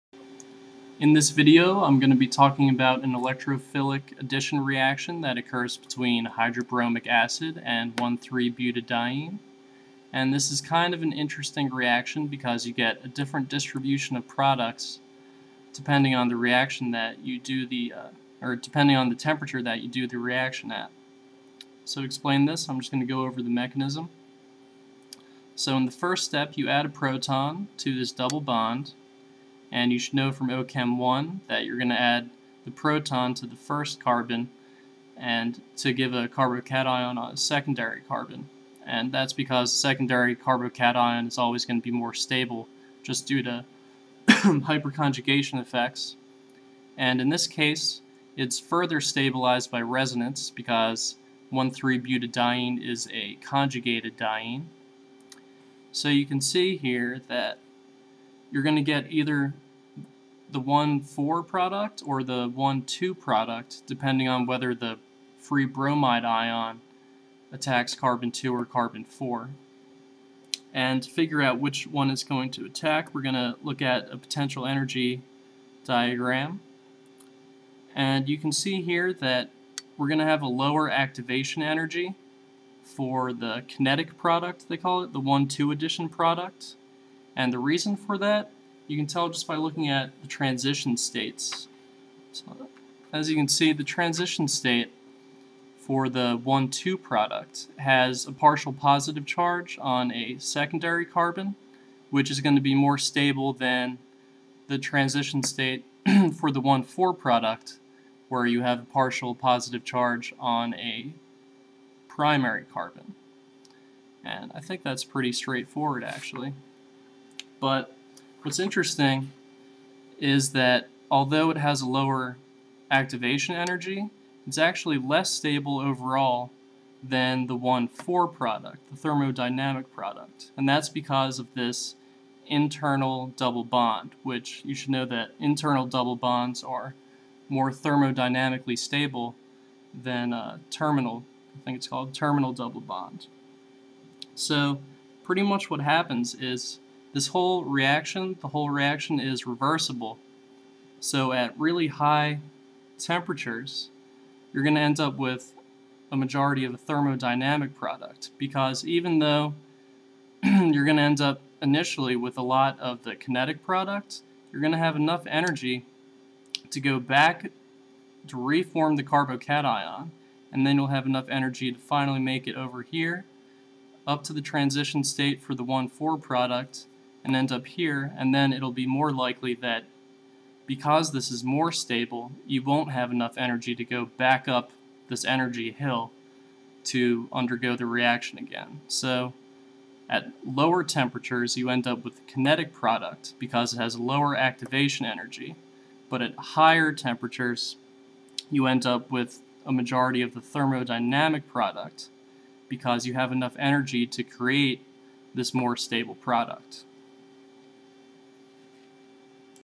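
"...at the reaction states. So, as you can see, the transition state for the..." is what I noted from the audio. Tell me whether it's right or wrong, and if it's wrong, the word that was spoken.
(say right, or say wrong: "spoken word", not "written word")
wrong: "transition", not "reaction".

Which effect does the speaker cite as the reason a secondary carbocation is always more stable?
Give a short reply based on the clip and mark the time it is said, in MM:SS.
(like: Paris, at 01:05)
hyperconjugation, at 00:44.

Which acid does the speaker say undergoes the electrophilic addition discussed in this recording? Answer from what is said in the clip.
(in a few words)
hydrobromic acid.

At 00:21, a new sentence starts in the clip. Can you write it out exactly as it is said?
So to explain this, I'm just going to go over the mechanism.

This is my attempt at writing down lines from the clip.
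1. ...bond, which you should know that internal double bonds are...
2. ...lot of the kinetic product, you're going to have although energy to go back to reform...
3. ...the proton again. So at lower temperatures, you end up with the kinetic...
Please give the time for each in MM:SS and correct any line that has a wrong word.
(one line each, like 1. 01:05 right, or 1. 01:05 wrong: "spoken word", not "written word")
1. 02:13 right
2. 02:42 wrong: "enough", not "although"
3. 03:07 wrong: "reaction", not "proton".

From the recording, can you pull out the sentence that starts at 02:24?
So pretty much what happens is this whole reaction, the whole reaction is reversible.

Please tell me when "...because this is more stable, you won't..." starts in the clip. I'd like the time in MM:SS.
03:00.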